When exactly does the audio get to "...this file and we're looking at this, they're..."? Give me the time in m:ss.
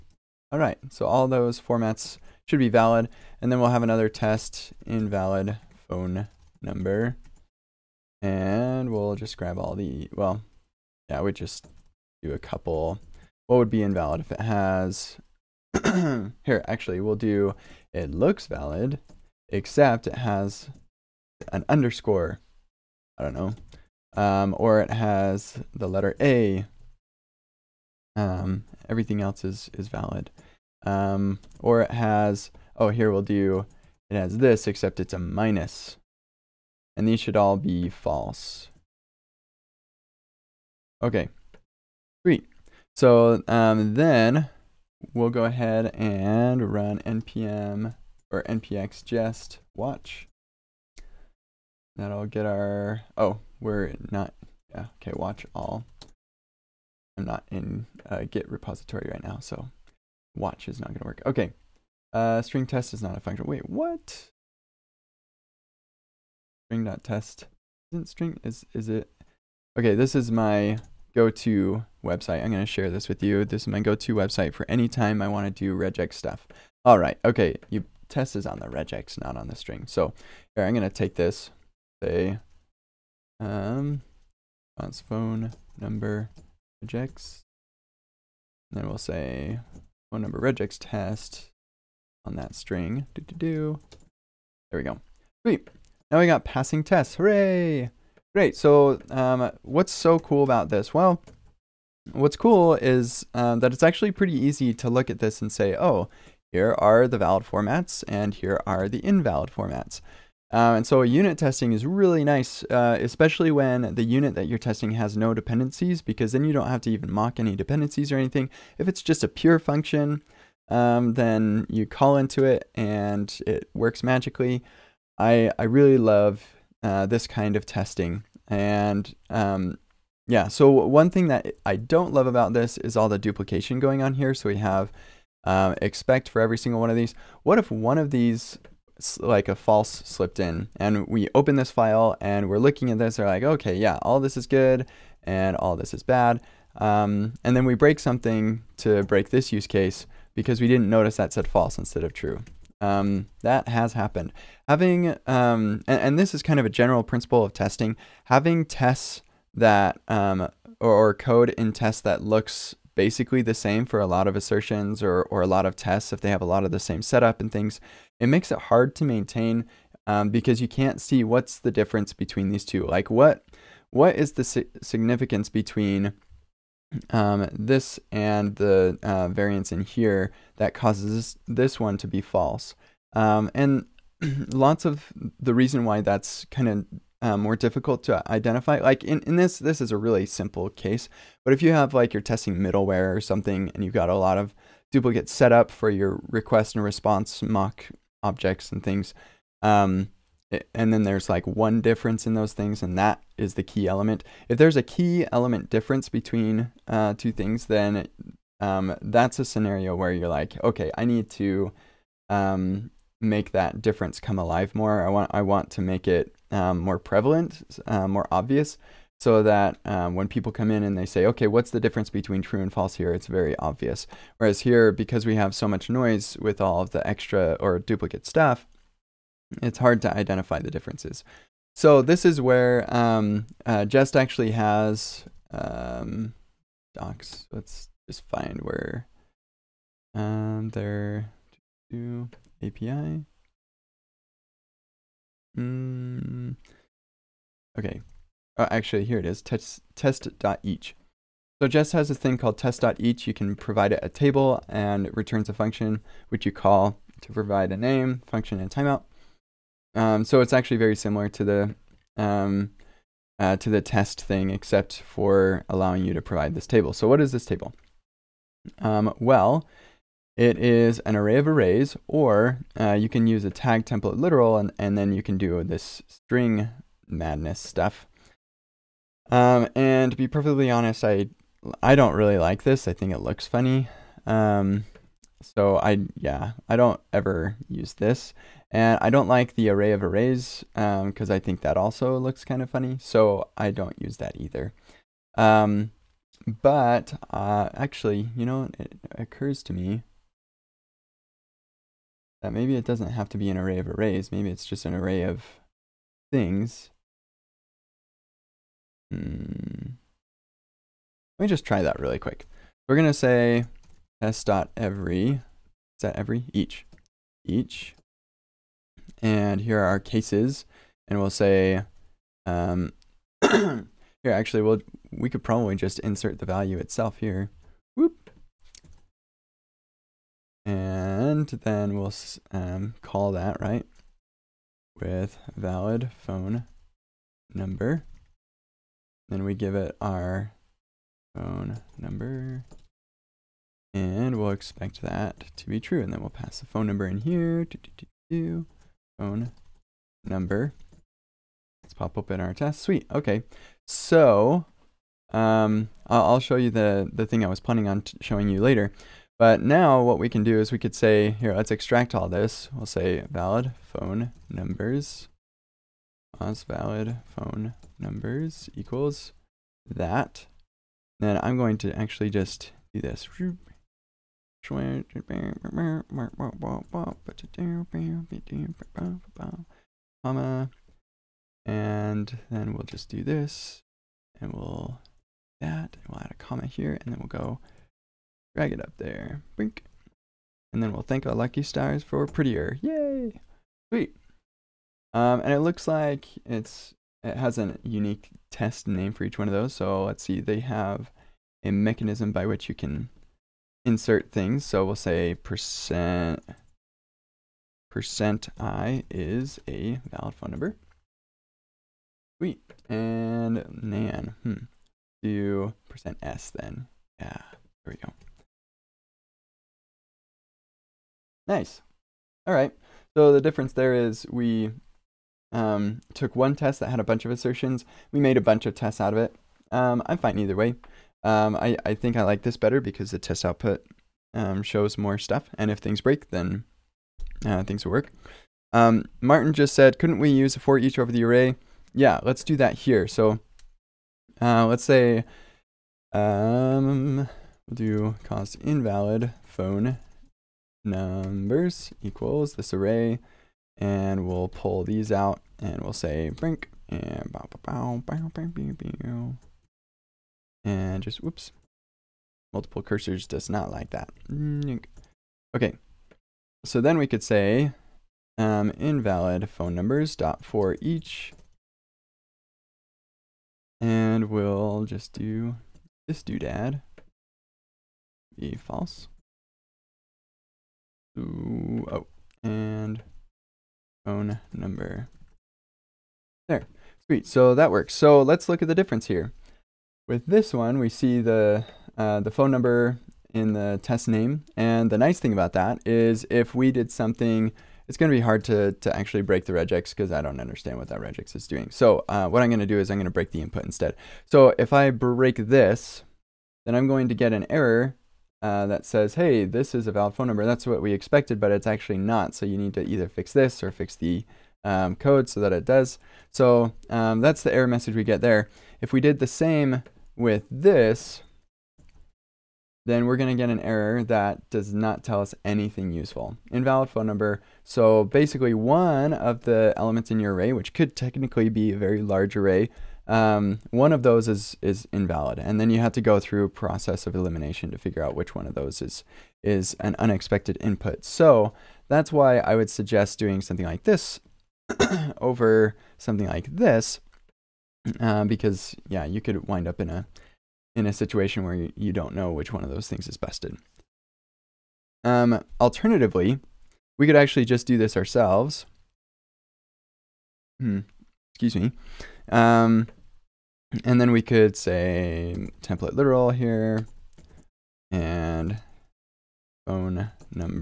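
2:21.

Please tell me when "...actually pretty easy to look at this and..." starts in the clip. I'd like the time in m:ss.
1:43.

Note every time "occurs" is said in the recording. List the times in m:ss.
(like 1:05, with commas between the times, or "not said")
4:59.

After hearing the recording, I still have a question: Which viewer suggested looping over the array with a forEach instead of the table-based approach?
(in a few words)
Martin.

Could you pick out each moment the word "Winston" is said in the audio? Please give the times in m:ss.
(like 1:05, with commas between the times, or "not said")
not said.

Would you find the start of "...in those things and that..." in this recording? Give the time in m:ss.
3:22.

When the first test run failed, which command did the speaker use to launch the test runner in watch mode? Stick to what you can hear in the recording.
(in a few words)
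npx jest.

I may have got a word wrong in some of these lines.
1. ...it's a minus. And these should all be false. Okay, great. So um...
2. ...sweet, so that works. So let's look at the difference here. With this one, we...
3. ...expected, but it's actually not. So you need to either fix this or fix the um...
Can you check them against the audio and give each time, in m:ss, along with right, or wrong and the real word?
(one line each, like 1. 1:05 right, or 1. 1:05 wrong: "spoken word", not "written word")
1. 0:34 right
2. 8:07 right
3. 8:30 right.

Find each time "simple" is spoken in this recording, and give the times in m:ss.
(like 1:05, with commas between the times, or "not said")
3:10.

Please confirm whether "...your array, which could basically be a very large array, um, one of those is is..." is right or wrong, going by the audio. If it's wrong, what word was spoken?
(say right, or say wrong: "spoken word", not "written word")
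wrong: "technically", not "basically".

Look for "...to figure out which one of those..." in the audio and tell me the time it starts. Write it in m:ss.
8:57.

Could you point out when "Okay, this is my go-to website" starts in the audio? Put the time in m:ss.
1:09.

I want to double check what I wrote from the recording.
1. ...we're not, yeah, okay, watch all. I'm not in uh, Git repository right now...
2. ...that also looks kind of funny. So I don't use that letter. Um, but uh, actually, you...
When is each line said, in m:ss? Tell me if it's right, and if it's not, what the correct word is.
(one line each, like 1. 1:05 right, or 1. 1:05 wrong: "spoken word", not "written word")
1. 0:53 right
2. 4:51 wrong: "either", not "letter".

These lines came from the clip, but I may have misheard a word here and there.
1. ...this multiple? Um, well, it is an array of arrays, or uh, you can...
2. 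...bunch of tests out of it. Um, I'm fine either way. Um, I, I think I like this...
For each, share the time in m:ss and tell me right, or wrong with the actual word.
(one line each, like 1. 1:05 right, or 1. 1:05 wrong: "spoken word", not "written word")
1. 4:27 wrong: "table", not "multiple"
2. 7:08 right.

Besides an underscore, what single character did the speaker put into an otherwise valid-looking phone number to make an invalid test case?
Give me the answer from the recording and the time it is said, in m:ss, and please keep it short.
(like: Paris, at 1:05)
the letter A, at 0:25.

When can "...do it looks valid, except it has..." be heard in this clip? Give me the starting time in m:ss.
0:17.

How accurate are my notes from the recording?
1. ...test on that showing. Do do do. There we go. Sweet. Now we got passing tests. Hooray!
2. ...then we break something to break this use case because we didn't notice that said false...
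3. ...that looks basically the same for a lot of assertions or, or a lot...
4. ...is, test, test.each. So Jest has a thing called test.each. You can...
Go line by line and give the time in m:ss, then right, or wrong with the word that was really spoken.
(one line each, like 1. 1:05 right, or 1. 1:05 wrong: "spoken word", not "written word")
1. 1:30 wrong: "string", not "showing"
2. 2:27 right
3. 2:42 right
4. 4:09 right.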